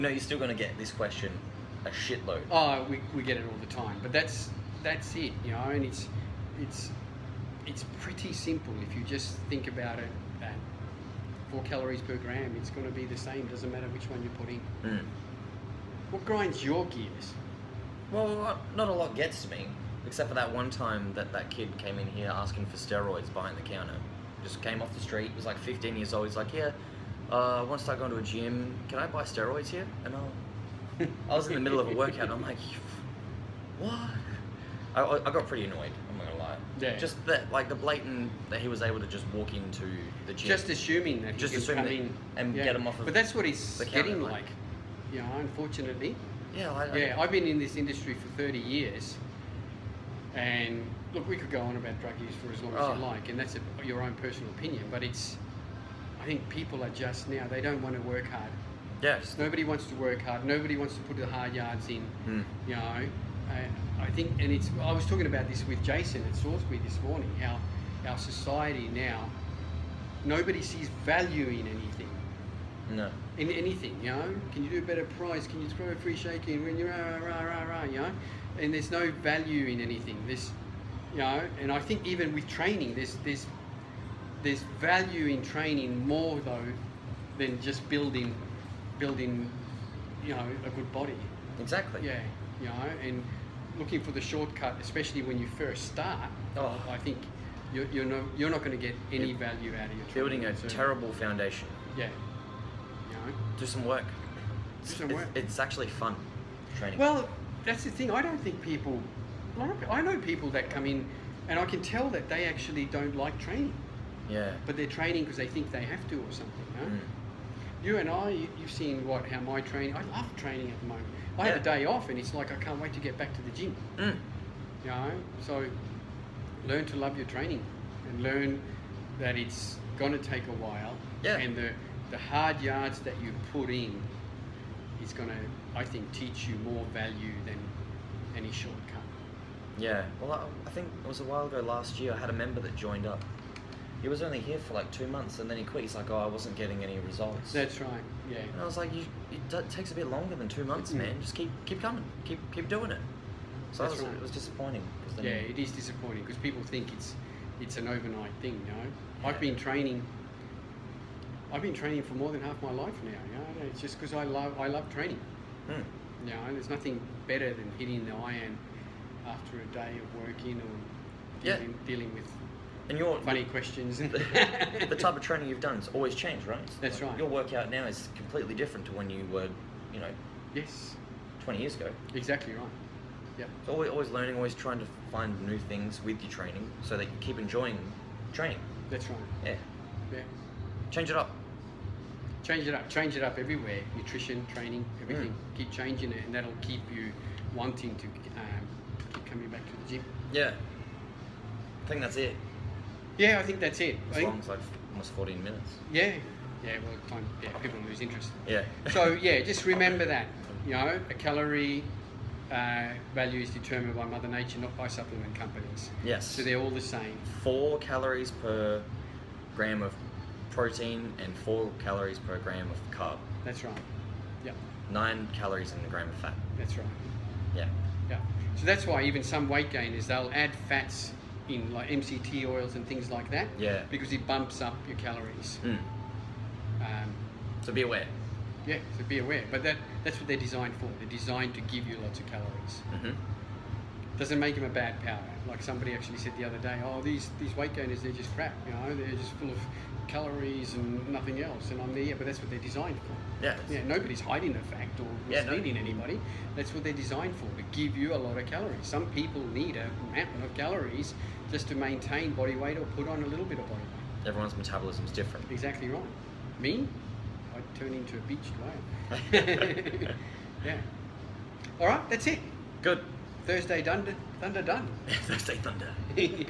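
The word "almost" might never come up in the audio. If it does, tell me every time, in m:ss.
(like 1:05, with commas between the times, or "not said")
3:24.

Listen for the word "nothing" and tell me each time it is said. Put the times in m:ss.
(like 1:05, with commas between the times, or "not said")
2:46, 4:11.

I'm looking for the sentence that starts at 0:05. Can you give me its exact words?
And it's it's it's pretty simple if you just think about it.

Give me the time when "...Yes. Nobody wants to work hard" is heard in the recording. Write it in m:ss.
0:59.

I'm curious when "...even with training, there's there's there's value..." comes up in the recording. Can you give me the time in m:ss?
1:22.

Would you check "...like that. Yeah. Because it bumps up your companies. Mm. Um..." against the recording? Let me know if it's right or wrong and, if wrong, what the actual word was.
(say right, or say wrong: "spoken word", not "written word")
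wrong: "calories", not "companies".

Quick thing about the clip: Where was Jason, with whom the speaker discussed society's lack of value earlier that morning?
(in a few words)
Salisbury.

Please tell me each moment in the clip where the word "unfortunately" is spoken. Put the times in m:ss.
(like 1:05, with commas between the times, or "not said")
0:45.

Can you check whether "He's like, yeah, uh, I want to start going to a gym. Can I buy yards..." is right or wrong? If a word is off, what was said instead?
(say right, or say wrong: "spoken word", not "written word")
wrong: "steroids", not "yards".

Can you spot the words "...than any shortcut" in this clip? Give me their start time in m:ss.
2:17.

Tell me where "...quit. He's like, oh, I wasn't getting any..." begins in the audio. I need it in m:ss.
2:25.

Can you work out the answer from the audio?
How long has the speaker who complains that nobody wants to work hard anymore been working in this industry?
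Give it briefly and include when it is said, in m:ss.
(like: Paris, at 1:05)
30 years, at 0:48.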